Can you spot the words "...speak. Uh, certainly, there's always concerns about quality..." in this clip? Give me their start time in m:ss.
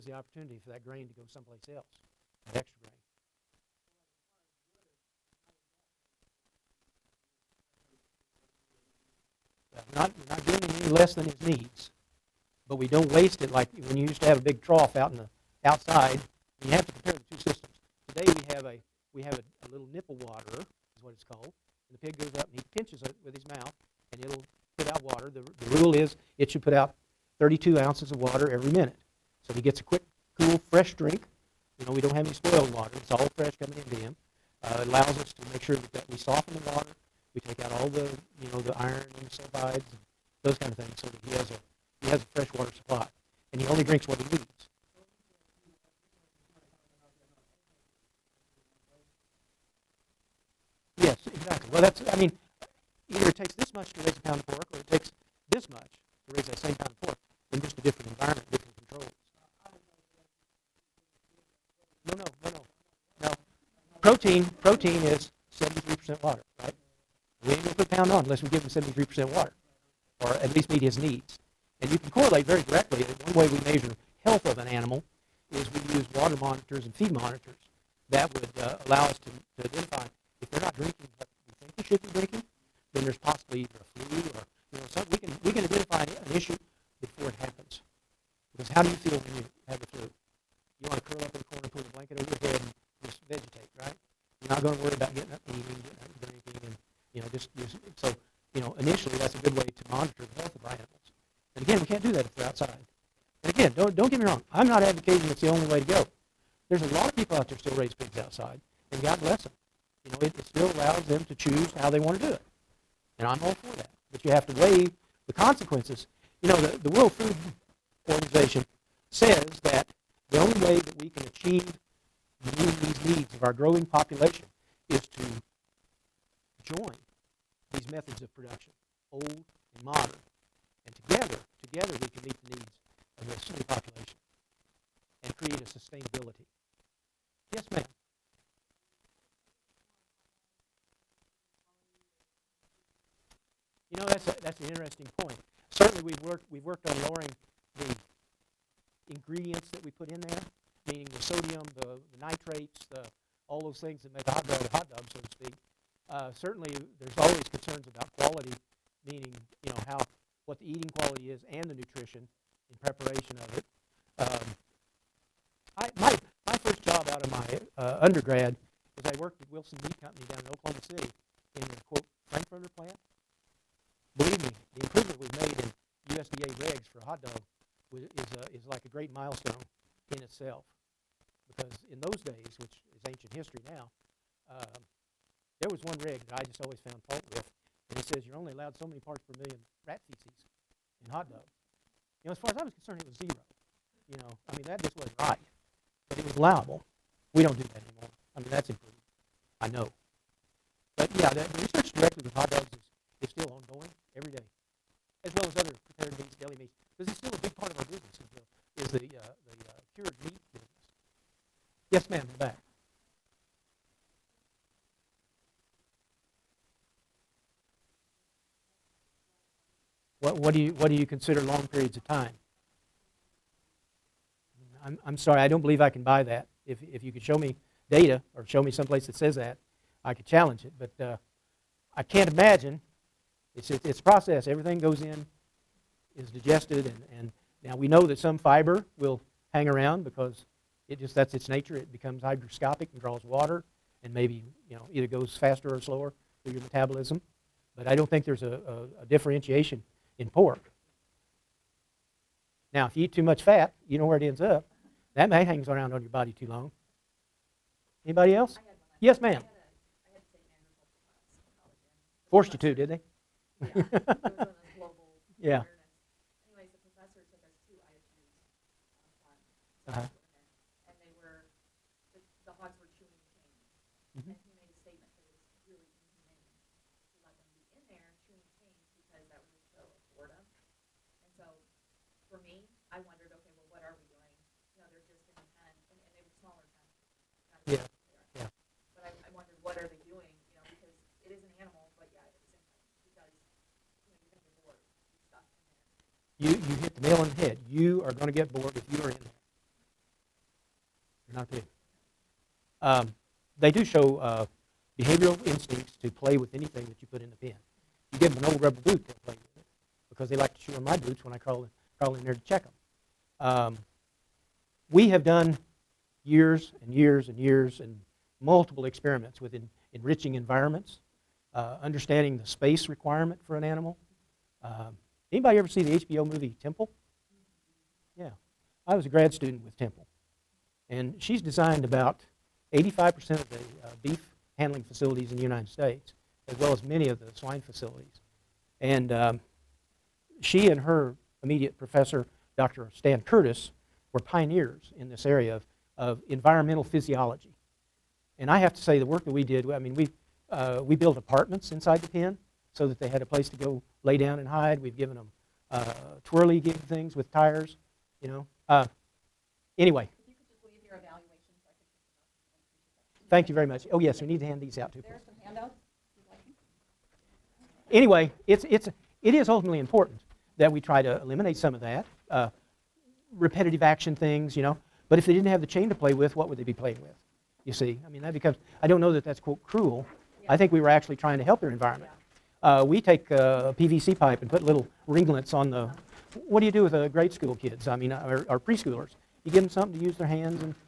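2:35.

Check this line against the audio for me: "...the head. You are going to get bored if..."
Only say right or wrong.
right.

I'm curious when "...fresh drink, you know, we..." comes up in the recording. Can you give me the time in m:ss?
0:30.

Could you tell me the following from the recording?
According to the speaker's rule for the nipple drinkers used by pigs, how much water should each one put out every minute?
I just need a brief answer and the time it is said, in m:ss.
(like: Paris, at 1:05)
32 ounces, at 0:27.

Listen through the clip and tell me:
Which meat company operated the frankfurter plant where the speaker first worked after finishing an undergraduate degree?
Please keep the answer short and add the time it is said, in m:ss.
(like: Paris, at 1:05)
Wilson Meat Company, at 2:49.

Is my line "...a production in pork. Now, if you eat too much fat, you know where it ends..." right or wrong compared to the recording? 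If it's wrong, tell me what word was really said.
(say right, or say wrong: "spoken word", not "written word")
wrong: "differentiation", not "production".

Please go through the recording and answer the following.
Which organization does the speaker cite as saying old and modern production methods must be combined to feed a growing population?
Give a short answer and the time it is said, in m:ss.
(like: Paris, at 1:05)
World Food Organization, at 1:56.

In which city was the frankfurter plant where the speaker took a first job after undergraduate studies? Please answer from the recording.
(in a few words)
Oklahoma City.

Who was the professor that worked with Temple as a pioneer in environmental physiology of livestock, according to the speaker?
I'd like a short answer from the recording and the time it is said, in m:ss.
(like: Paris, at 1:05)
Dr. Stan Curtis, at 5:42.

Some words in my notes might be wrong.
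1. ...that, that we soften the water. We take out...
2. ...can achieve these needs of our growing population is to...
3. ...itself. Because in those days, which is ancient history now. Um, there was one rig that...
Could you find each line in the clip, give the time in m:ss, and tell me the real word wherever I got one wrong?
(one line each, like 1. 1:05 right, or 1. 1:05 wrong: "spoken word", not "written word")
1. 0:35 right
2. 2:01 right
3. 3:00 right.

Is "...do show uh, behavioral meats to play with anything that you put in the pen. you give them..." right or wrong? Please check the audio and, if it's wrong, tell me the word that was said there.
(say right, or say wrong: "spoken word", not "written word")
wrong: "instincts", not "meats".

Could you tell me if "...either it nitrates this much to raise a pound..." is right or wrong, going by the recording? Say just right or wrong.
wrong.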